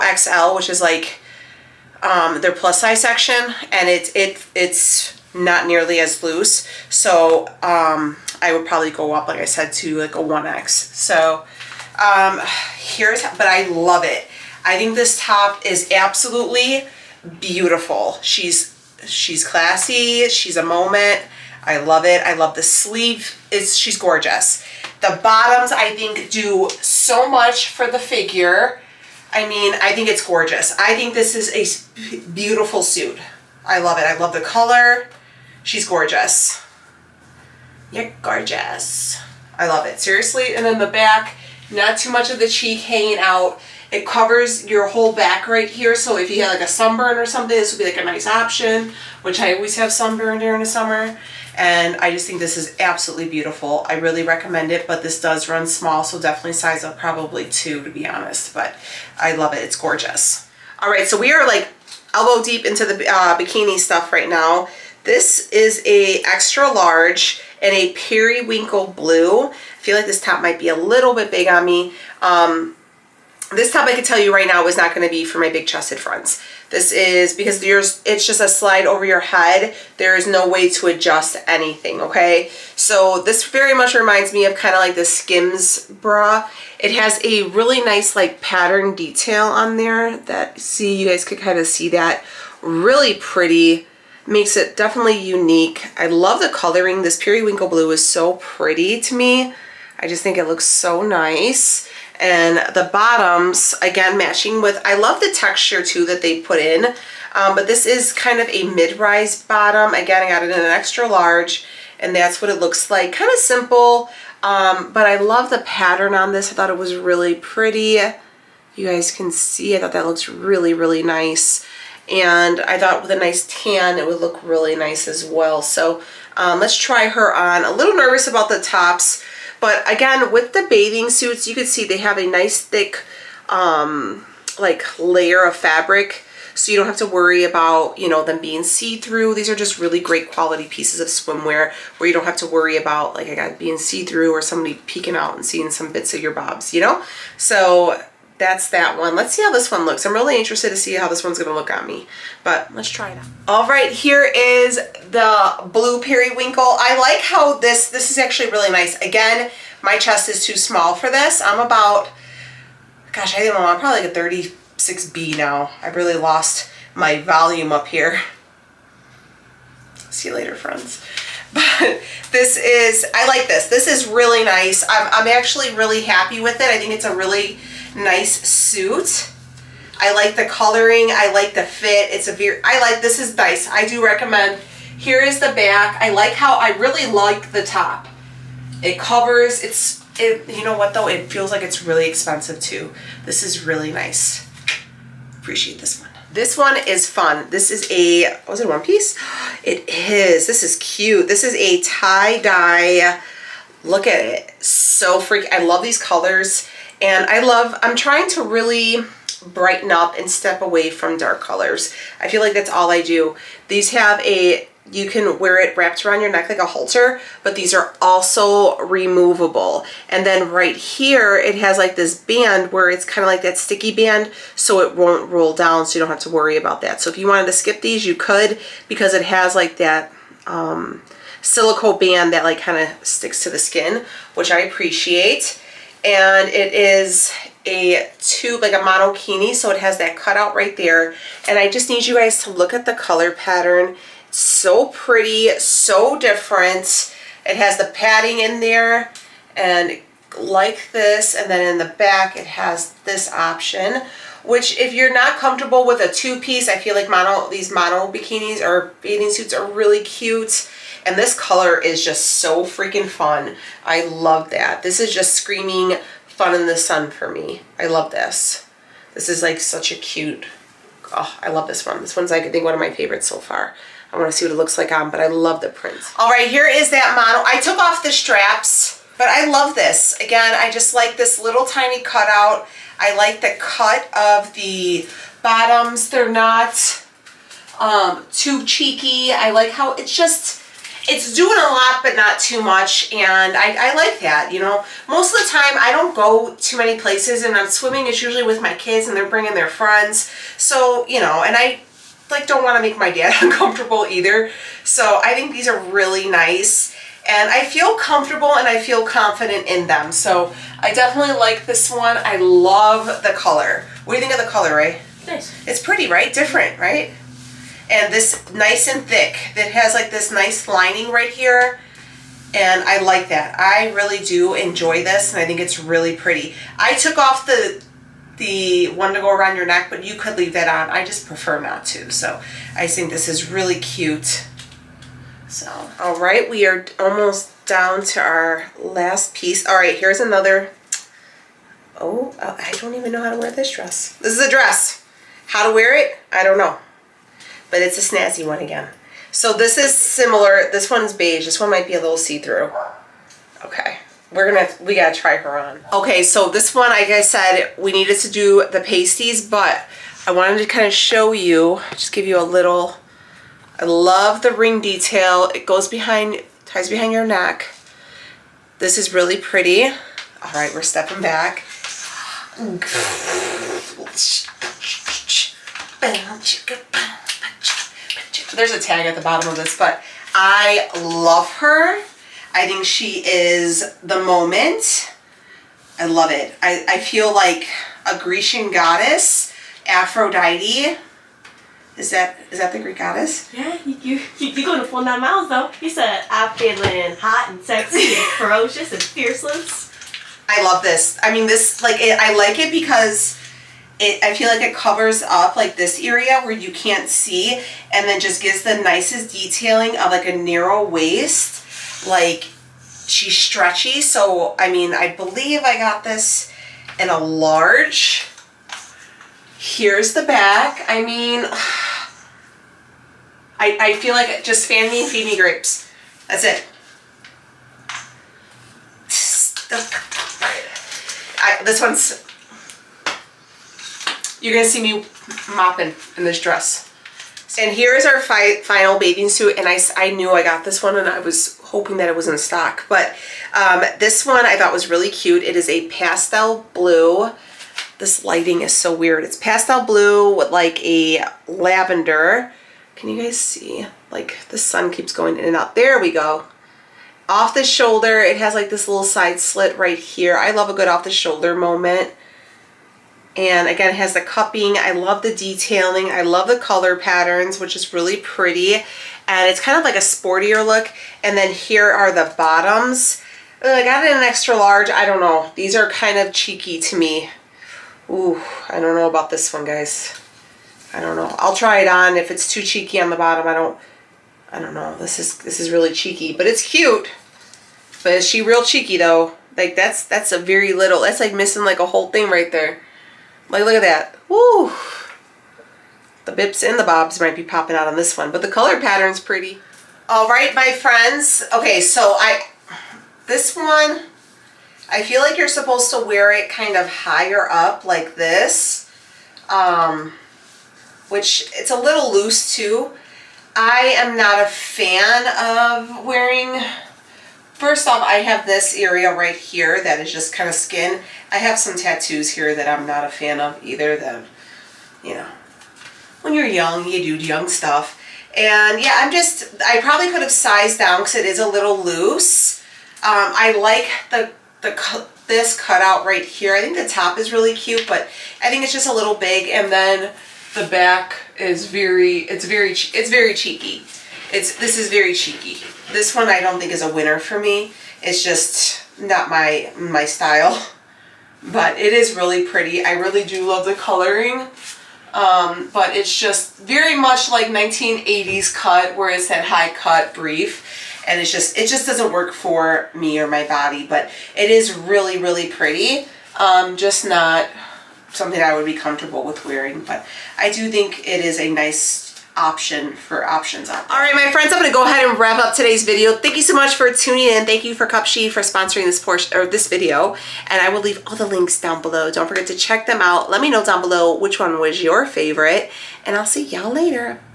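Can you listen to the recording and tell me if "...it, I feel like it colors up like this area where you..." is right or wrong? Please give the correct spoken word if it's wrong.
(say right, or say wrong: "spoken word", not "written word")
wrong: "covers", not "colors".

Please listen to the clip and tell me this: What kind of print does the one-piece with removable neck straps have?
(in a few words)
tie-dye.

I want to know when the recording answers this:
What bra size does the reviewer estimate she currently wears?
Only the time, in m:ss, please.
2:44.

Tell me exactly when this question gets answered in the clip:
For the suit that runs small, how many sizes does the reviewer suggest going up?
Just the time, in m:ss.
0:56.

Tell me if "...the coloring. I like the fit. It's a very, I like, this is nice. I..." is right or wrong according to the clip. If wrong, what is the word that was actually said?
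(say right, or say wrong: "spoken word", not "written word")
right.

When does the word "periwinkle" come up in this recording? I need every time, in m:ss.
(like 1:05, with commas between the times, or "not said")
1:07, 1:37, 2:36.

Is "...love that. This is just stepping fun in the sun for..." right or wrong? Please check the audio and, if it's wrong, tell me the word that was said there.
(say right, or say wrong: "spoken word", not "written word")
wrong: "screaming", not "stepping".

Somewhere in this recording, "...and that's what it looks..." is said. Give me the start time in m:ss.
1:51.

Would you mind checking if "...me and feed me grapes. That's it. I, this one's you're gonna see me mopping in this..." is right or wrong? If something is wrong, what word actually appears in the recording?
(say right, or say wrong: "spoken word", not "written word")
right.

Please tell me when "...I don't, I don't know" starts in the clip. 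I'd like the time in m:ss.
8:03.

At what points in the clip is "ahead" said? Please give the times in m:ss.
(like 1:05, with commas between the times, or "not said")
9:34.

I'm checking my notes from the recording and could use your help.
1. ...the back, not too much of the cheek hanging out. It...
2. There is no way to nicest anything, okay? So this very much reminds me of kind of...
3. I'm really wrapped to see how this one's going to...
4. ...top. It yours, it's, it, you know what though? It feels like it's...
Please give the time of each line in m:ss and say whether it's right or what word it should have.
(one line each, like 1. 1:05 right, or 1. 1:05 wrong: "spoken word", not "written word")
1. 0:40 right
2. 1:19 wrong: "adjust", not "nicest"
3. 2:30 wrong: "interested", not "wrapped"
4. 3:07 wrong: "covers", not "yours".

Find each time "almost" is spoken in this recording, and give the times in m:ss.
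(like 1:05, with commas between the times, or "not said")
5:36.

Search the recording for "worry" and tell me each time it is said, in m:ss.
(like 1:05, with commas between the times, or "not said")
2:17, 2:22, 3:46.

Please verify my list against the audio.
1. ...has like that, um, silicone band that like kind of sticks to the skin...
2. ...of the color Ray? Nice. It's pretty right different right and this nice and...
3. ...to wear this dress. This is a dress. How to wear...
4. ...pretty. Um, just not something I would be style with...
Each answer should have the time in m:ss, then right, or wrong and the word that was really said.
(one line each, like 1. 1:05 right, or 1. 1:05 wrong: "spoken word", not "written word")
1. 3:49 right
2. 5:14 right
3. 5:43 right
4. 9:25 wrong: "comfortable", not "style".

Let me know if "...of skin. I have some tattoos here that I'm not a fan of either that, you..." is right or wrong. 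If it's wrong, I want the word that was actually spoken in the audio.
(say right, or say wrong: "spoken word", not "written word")
right.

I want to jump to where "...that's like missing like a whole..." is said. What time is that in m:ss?
8:11.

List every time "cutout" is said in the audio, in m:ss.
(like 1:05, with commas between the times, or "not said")
4:00, 4:42, 8:55.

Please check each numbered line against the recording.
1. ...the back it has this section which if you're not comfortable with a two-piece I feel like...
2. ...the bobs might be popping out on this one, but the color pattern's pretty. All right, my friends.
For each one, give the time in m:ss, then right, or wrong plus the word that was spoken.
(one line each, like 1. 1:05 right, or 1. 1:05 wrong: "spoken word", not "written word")
1. 4:11 wrong: "option", not "section"
2. 8:16 right.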